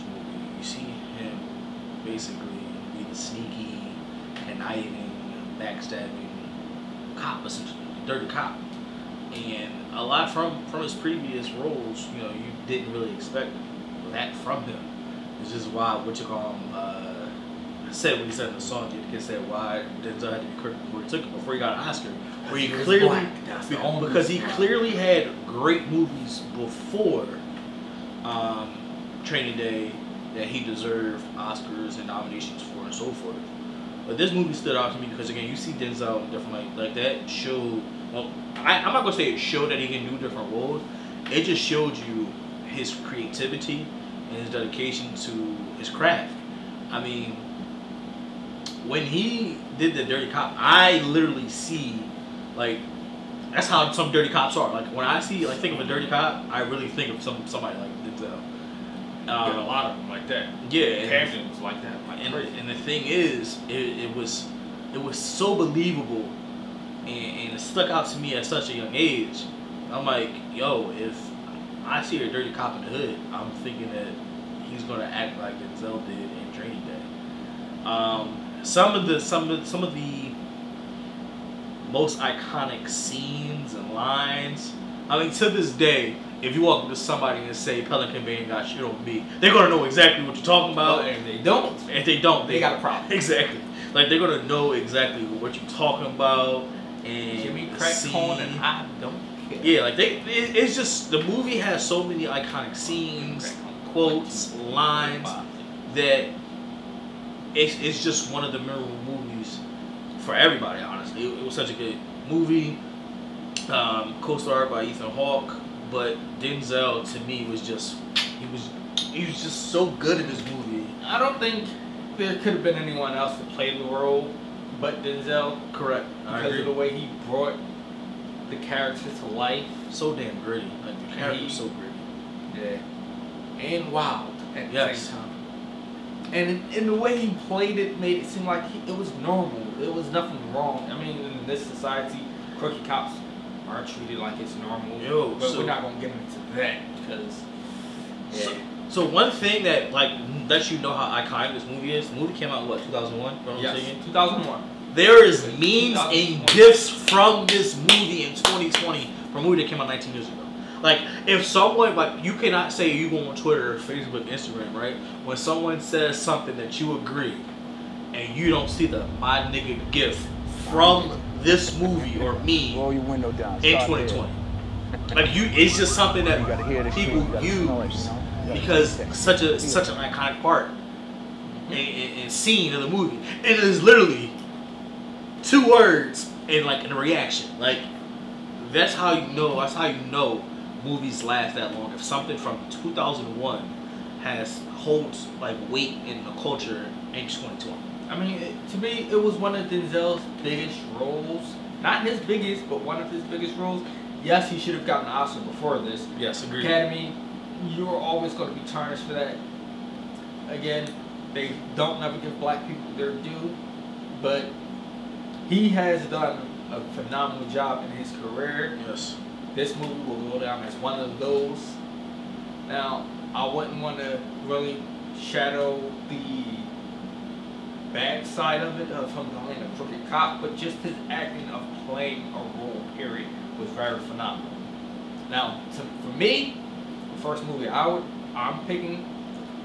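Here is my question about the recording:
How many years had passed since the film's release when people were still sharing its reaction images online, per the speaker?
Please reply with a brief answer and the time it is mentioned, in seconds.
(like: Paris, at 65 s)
19, at 159 s.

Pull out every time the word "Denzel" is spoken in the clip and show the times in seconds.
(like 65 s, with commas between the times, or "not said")
20 s, 35 s, 75 s, 116 s, 125 s, 199 s.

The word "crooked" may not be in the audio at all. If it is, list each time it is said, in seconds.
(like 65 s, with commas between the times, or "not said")
142 s, 229 s.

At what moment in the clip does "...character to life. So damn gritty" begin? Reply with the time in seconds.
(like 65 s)
128 s.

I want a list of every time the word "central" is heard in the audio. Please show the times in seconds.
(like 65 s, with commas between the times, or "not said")
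not said.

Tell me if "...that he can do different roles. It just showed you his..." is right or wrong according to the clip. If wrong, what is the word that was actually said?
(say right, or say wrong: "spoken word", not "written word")
right.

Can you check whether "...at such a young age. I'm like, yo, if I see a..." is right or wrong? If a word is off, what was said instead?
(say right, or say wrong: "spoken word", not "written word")
right.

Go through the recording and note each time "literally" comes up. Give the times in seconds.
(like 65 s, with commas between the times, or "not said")
51 s, 183 s.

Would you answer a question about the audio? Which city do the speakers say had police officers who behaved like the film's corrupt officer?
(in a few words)
Camden.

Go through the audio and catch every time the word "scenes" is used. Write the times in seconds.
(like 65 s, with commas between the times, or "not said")
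82 s, 102 s, 182 s.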